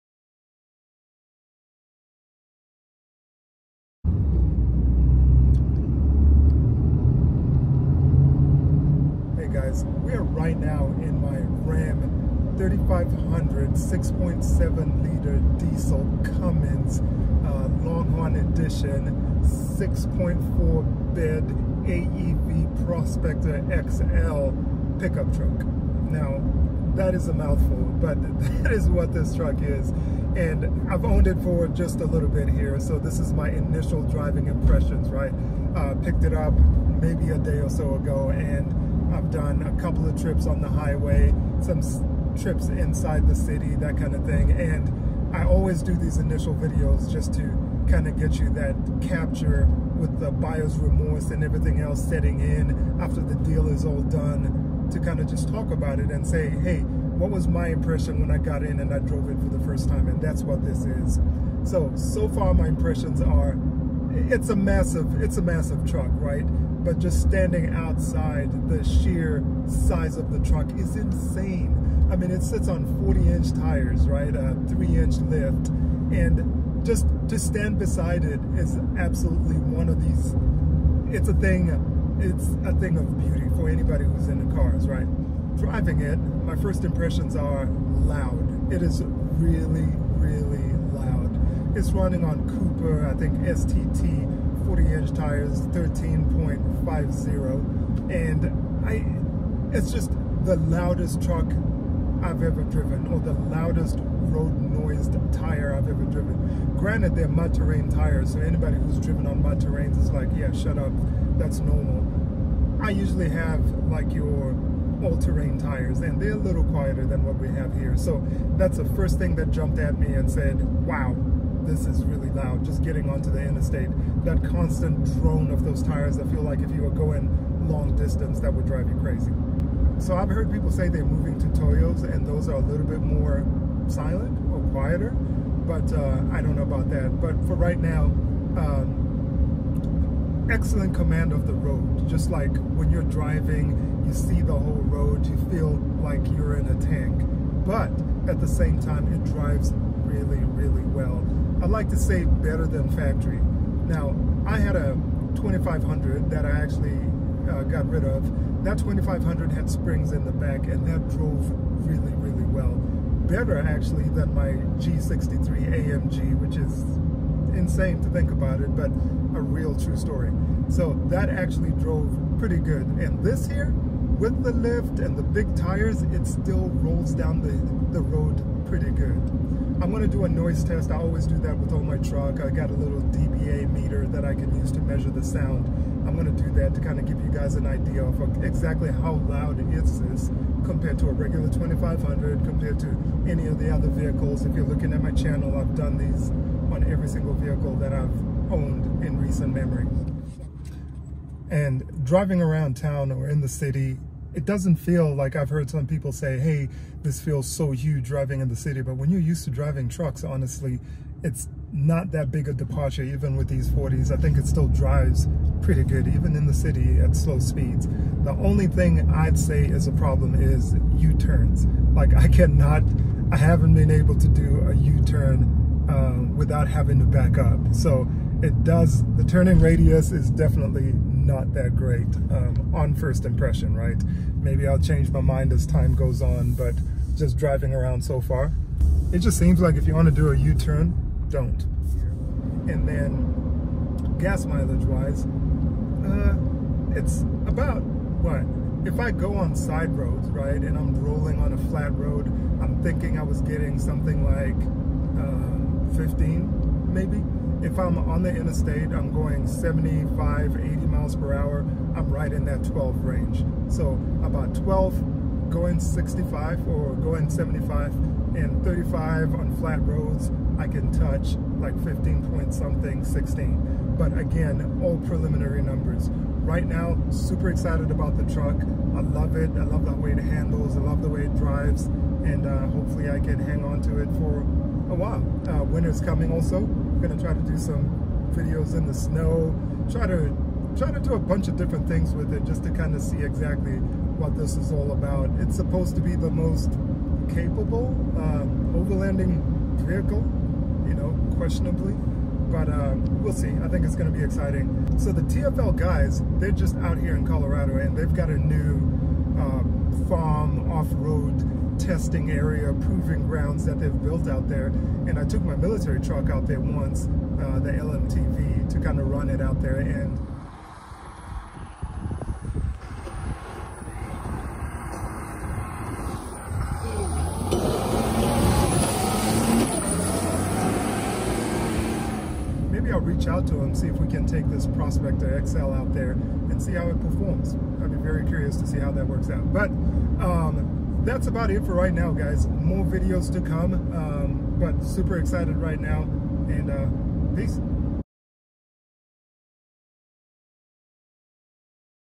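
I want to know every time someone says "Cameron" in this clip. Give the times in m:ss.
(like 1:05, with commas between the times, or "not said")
not said.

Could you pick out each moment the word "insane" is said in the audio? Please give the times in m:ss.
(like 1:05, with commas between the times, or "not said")
1:10, 2:47.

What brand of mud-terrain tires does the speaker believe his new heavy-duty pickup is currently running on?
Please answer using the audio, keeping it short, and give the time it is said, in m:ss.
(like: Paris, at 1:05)
Cooper, at 1:32.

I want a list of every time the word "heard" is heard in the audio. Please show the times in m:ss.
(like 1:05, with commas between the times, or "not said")
2:10, 3:25.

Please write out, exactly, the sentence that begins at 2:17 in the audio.
But for right now, um, excellent command of the road.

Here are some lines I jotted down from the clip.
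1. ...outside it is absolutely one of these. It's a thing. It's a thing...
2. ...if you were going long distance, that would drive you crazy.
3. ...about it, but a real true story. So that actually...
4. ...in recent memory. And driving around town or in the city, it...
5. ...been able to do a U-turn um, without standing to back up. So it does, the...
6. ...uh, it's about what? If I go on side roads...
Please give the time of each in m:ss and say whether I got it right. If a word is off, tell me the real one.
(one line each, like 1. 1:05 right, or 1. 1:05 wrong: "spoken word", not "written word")
1. 1:17 wrong: "beside", not "outside"
2. 2:06 right
3. 2:48 right
4. 3:19 right
5. 3:43 wrong: "having", not "standing"
6. 4:06 right.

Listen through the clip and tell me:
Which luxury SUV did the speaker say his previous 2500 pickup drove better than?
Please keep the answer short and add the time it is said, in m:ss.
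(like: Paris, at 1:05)
G63 AMG, at 2:44.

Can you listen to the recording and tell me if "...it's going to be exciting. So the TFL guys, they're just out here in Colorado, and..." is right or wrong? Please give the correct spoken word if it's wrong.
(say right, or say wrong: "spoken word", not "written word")
right.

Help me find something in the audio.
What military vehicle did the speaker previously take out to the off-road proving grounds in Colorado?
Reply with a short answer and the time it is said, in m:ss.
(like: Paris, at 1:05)
LMTV, at 5:17.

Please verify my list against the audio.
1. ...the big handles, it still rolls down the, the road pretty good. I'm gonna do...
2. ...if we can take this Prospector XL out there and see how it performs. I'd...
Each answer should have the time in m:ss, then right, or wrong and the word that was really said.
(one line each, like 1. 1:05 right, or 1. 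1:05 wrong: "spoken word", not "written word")
1. 2:55 wrong: "tires", not "handles"
2. 5:33 right.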